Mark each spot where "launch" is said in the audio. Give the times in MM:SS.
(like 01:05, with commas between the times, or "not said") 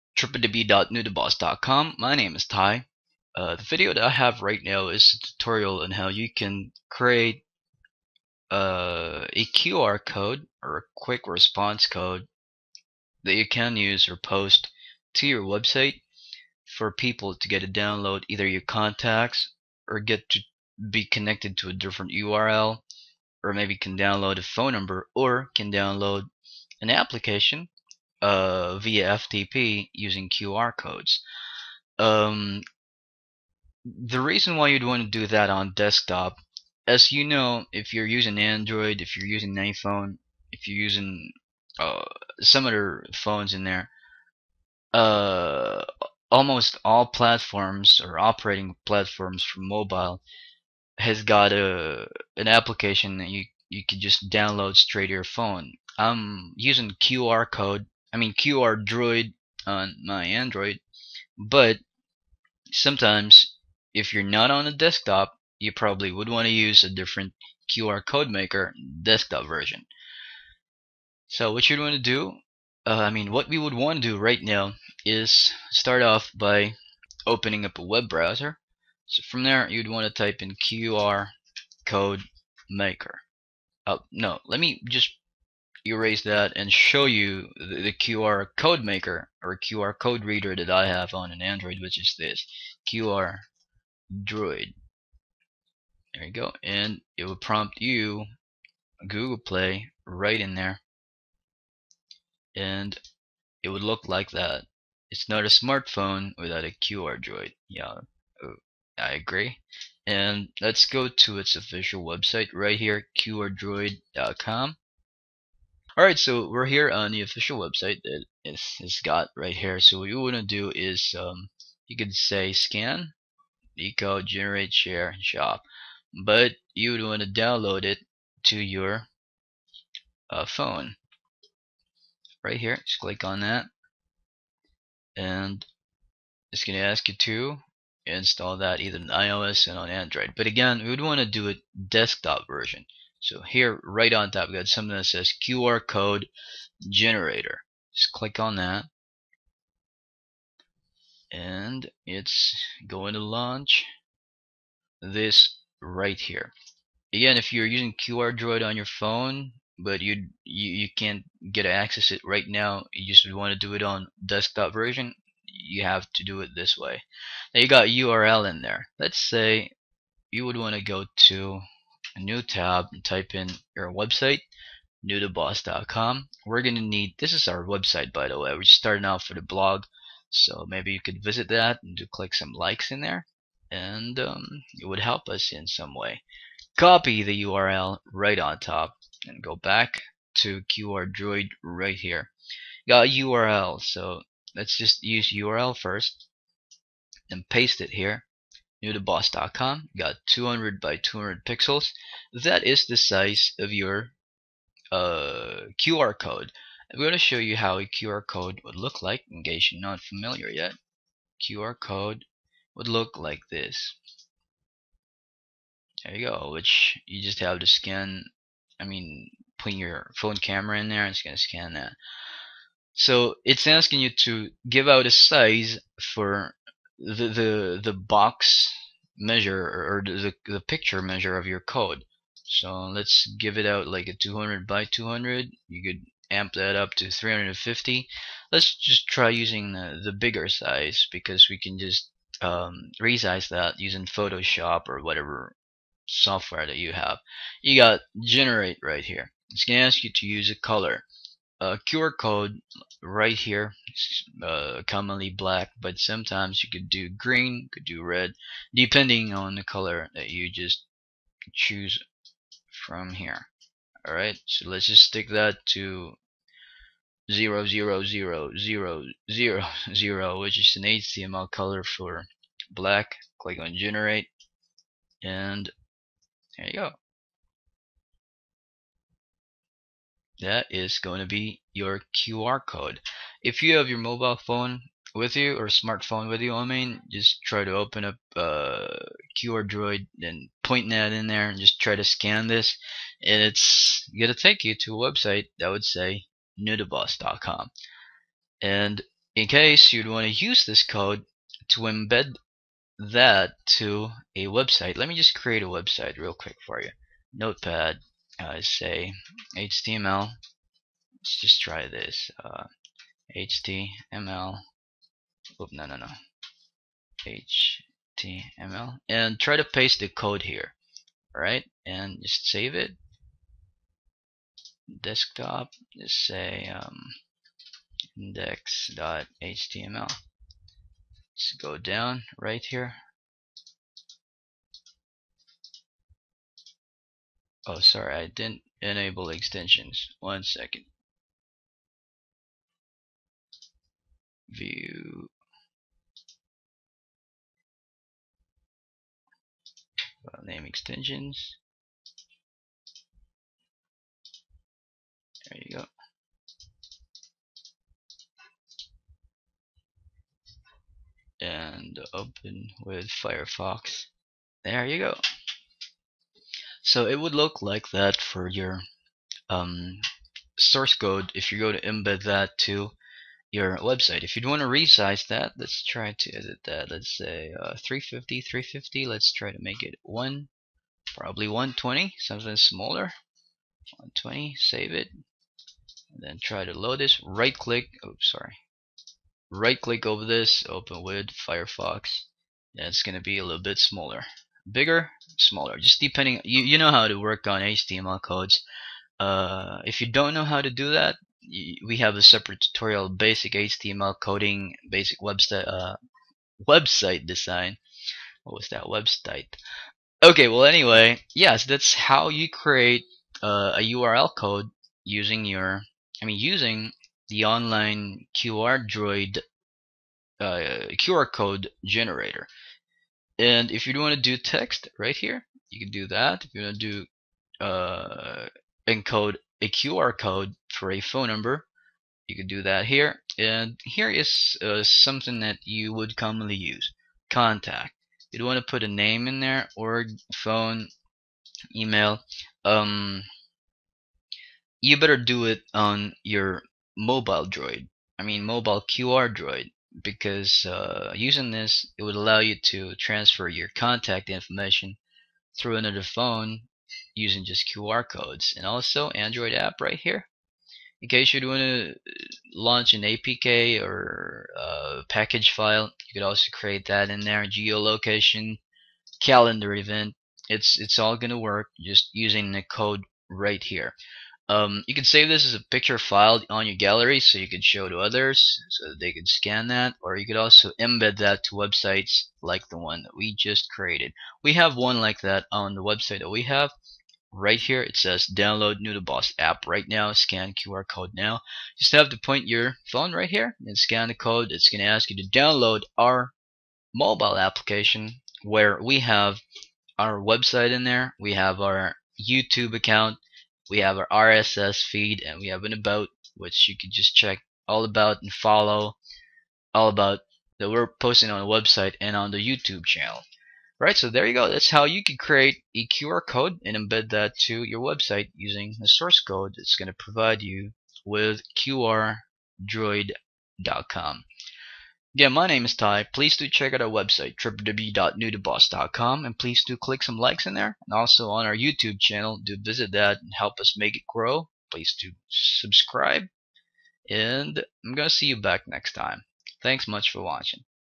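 02:33, 07:42.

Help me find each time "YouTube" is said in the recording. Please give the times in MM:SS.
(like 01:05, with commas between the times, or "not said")
08:22, 08:32, 08:51.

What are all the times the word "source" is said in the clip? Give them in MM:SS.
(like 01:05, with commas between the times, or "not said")
06:10, 08:38.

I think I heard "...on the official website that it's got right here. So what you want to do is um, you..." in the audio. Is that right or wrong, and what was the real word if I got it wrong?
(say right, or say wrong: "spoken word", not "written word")
right.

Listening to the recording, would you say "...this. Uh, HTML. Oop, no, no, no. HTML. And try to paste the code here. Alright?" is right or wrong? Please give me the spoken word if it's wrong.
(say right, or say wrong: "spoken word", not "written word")
right.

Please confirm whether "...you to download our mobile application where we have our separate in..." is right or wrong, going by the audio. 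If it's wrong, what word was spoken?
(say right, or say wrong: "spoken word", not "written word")
wrong: "website", not "separate".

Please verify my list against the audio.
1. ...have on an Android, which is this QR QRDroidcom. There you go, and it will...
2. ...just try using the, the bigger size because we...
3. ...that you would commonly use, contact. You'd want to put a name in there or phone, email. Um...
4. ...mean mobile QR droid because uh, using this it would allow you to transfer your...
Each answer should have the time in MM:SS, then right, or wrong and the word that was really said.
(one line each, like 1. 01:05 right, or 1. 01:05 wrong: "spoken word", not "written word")
1. 01:30 wrong: "Droid", not "QRDroidcom"
2. 03:58 right
3. 07:15 right
4. 07:28 right.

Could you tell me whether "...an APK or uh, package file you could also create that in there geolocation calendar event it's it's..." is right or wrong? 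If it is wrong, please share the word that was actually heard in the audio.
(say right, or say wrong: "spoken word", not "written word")
right.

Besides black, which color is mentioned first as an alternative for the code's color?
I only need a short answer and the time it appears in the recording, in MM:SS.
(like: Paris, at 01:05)
green, at 04:17.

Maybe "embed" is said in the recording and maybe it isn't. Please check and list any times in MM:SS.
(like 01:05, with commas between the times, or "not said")
05:01, 06:11, 08:00, 08:36.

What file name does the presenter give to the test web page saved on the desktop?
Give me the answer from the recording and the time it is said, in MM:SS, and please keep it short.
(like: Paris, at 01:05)
index.html, at 05:28.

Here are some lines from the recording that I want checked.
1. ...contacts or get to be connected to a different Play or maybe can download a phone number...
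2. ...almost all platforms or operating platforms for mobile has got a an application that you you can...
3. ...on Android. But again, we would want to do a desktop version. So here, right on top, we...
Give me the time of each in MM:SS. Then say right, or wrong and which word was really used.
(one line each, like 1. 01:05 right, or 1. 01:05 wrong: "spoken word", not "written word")
1. 00:18 wrong: "URL", not "Play"
2. 00:46 right
3. 02:19 right.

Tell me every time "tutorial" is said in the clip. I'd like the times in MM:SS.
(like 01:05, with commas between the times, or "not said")
00:05, 06:42.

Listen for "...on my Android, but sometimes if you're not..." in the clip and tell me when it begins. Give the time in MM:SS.
00:59.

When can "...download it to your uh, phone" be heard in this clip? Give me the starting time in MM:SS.
02:07.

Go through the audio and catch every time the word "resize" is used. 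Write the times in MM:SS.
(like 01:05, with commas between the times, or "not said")
04:03, 06:14.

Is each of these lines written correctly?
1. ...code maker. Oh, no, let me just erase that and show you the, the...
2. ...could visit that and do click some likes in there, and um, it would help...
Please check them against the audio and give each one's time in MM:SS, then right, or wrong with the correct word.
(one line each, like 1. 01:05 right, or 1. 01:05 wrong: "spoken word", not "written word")
1. 01:21 right
2. 03:00 right.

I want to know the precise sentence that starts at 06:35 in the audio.
Just depending, you, you know how to work on HTML codes.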